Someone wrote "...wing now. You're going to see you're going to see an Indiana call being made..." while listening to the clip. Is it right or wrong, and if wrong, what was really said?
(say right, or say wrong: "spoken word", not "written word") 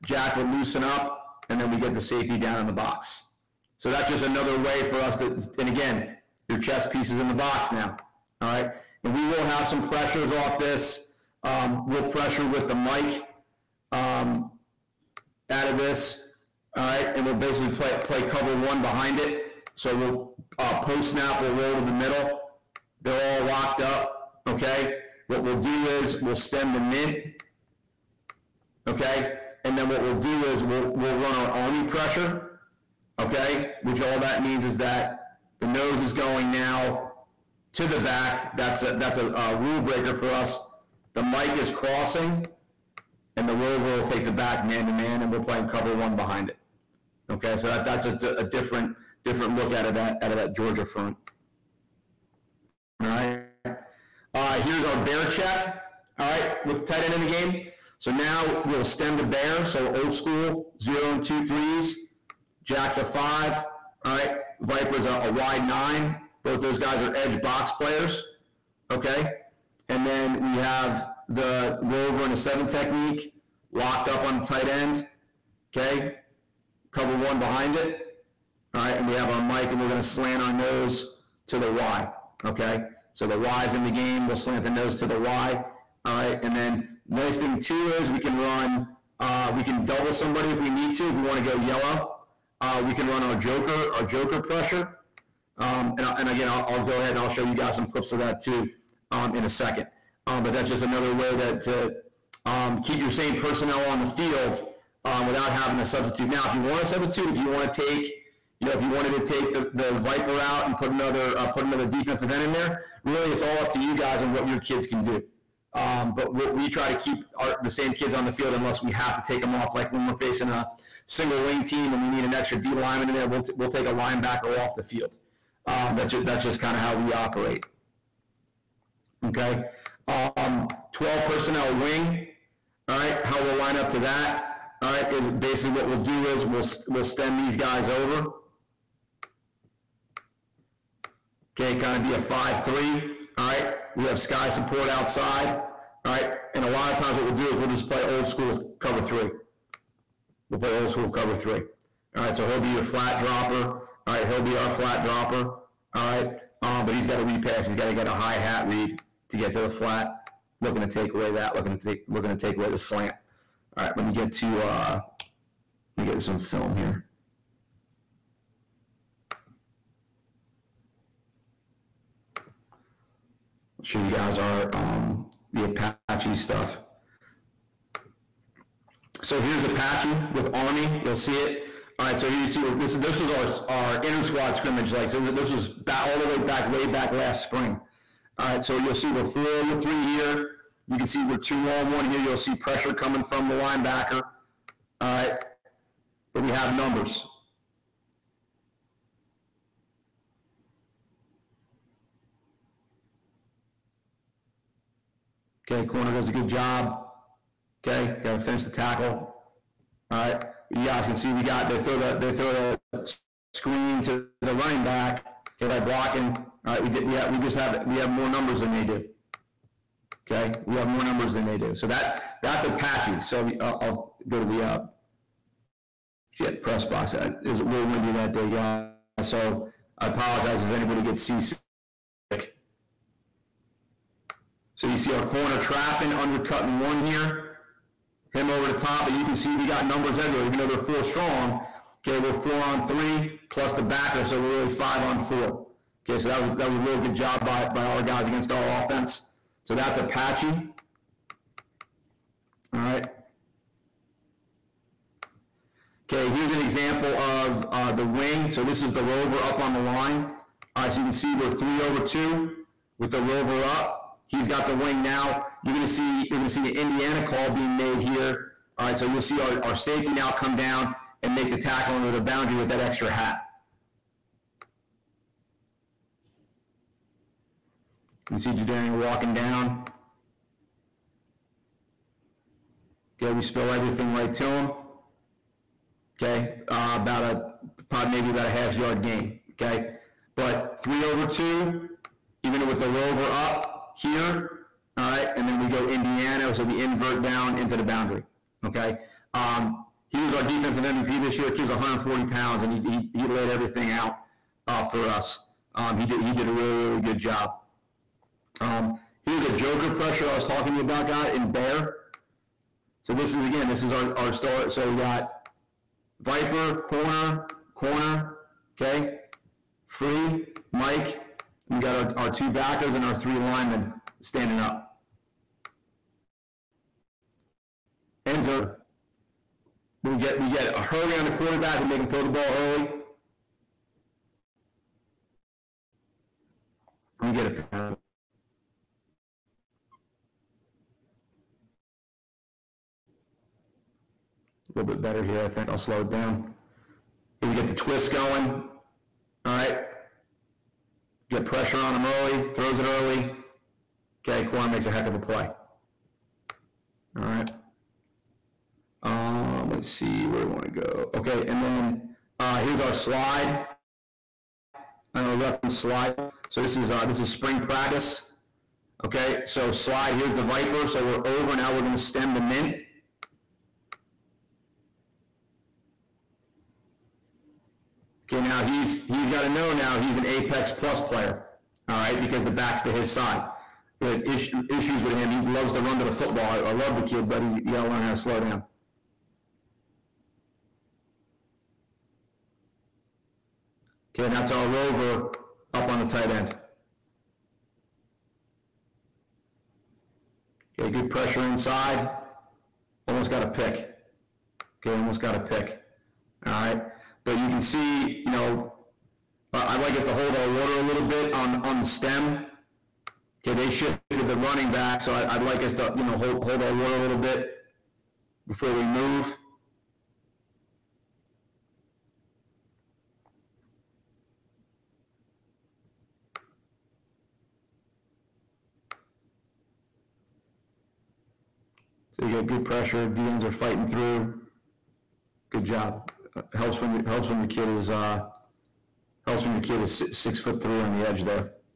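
right.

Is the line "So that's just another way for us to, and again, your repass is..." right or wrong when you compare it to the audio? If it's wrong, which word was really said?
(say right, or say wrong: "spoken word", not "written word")
wrong: "chess", not "repass".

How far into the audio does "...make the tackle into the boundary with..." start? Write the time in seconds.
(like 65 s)
271 s.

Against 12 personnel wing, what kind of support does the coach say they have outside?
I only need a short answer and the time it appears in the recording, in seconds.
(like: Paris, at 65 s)
sky support, at 144 s.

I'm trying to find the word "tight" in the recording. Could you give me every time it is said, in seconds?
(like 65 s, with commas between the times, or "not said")
56 s, 74 s, 396 s.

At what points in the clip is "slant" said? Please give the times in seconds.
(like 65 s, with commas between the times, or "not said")
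80 s, 84 s, 162 s.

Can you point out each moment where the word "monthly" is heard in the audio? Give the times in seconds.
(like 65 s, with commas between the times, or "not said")
not said.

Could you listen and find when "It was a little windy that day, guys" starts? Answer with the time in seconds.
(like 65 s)
227 s.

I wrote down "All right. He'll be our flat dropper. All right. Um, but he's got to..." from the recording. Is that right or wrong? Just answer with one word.
right.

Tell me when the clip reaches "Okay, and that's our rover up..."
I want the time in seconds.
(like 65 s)
394 s.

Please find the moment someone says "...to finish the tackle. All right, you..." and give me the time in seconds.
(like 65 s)
208 s.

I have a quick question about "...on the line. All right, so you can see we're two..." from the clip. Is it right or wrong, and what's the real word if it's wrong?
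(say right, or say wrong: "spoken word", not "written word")
wrong: "three", not "two".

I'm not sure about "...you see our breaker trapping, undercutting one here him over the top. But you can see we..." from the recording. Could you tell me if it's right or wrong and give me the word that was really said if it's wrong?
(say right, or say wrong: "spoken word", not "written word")
wrong: "corner", not "breaker".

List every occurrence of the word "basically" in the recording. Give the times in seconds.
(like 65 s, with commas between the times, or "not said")
17 s, 135 s.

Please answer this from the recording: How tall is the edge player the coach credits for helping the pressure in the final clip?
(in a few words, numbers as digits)
6 foot 3.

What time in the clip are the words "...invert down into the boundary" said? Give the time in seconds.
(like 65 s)
296 s.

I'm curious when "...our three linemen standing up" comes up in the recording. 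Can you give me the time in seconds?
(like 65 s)
323 s.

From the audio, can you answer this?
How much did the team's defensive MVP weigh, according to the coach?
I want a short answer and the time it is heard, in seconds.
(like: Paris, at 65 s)
140 pounds, at 301 s.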